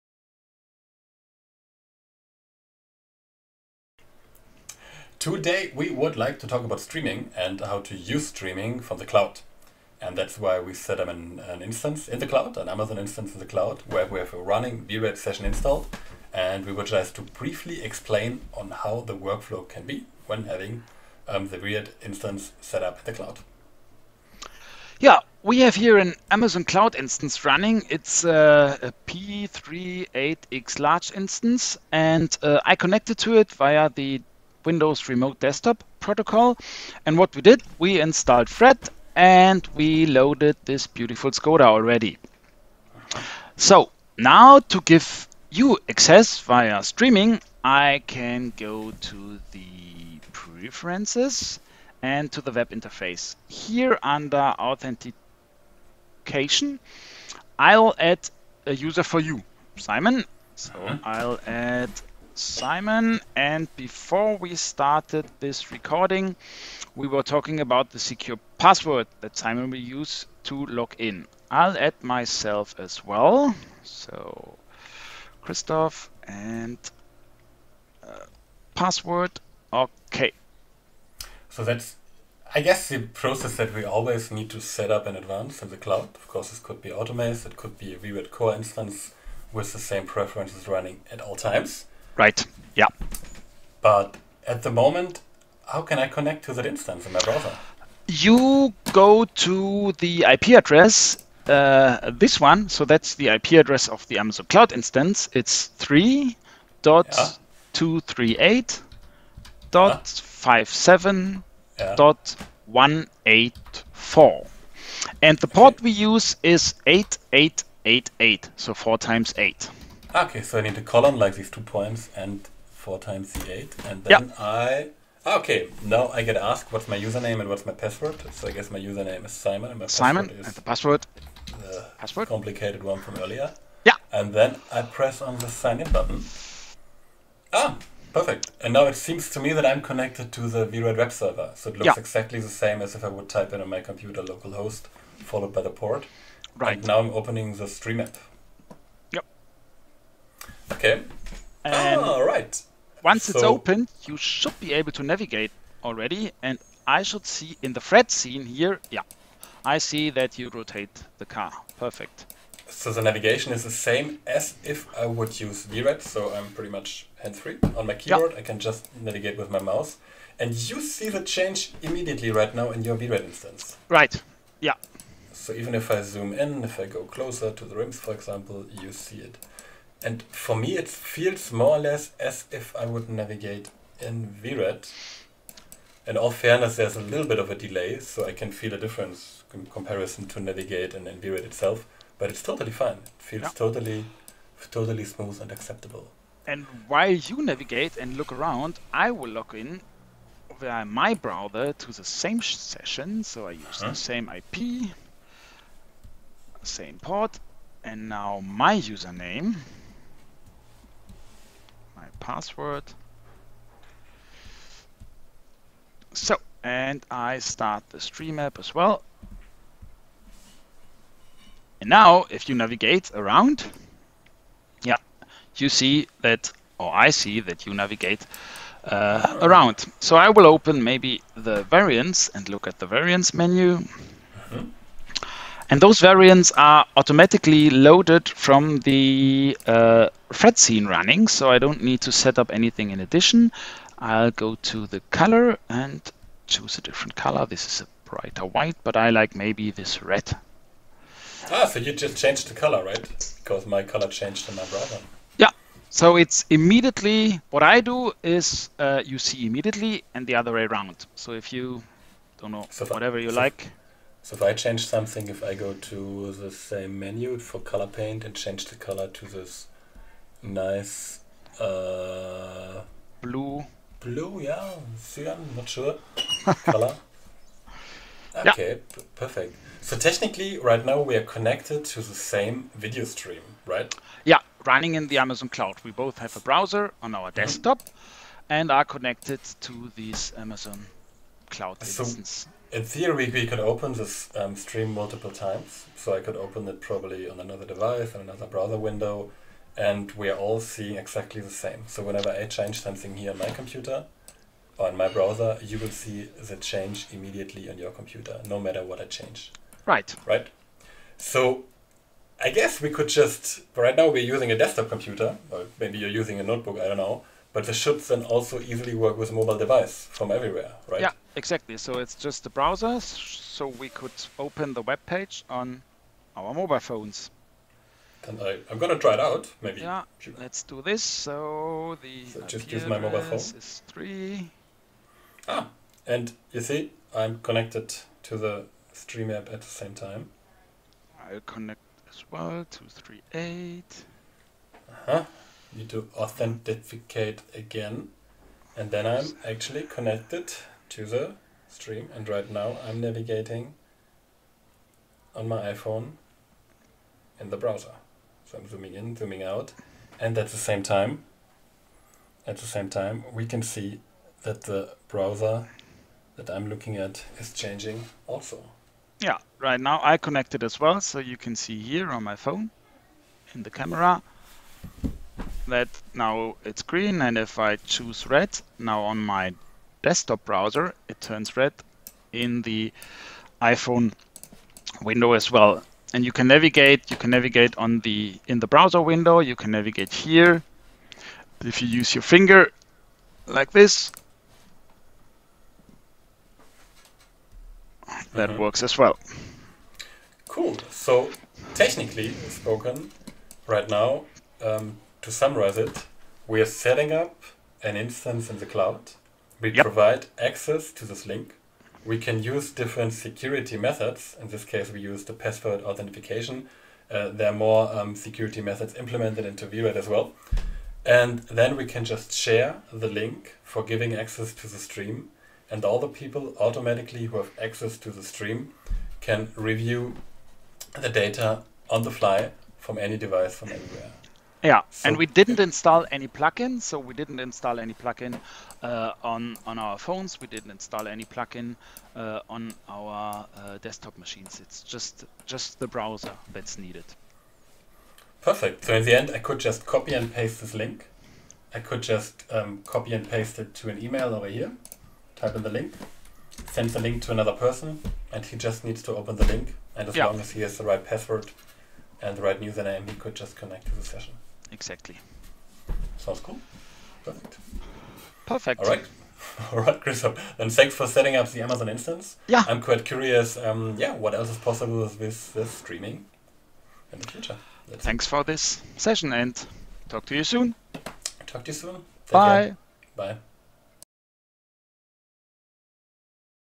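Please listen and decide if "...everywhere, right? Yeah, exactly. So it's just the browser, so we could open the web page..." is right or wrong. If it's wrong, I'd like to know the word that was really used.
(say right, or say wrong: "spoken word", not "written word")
right.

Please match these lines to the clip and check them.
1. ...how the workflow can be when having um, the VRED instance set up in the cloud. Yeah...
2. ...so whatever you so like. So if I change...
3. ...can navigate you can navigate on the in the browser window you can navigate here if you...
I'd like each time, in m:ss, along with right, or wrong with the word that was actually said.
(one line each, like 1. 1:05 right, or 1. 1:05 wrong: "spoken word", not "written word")
1. 0:18 right
2. 4:22 right
3. 6:26 right.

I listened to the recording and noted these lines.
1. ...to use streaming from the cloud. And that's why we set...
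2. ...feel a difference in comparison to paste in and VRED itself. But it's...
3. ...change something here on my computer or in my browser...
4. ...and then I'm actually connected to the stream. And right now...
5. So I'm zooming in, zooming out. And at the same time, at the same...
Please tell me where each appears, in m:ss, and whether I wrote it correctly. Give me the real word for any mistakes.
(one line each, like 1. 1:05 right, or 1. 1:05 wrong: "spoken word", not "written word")
1. 0:07 right
2. 3:08 wrong: "navigate", not "paste"
3. 5:02 right
4. 5:48 right
5. 5:58 right.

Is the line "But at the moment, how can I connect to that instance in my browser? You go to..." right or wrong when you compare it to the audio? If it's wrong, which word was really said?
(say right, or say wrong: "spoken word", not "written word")
right.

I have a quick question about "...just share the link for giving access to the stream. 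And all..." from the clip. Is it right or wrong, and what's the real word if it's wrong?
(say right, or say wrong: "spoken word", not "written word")
right.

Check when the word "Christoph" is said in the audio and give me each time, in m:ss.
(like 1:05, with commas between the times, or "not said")
1:15, 7:50.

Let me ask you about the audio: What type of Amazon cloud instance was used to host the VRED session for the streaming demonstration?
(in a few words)
P38X large.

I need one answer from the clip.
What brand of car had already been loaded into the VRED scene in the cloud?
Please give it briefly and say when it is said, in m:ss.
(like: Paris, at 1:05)
Skoda, at 0:41.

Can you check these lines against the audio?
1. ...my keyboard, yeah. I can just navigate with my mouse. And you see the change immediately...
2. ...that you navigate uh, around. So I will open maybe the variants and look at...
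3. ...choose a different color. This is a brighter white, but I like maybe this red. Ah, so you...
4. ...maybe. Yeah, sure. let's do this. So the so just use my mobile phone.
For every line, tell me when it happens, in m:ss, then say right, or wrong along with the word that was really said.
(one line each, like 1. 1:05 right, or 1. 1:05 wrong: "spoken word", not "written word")
1. 2:47 right
2. 3:47 right
3. 4:06 right
4. 5:29 right.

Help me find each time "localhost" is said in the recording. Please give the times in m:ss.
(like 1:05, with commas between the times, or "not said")
2:24.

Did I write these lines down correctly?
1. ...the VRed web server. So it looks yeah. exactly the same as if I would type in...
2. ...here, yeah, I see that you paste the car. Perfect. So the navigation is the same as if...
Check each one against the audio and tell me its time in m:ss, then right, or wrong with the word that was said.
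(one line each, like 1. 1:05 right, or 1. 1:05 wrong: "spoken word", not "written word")
1. 2:20 right
2. 2:38 wrong: "rotate", not "paste".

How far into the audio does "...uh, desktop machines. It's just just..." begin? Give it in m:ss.
7:23.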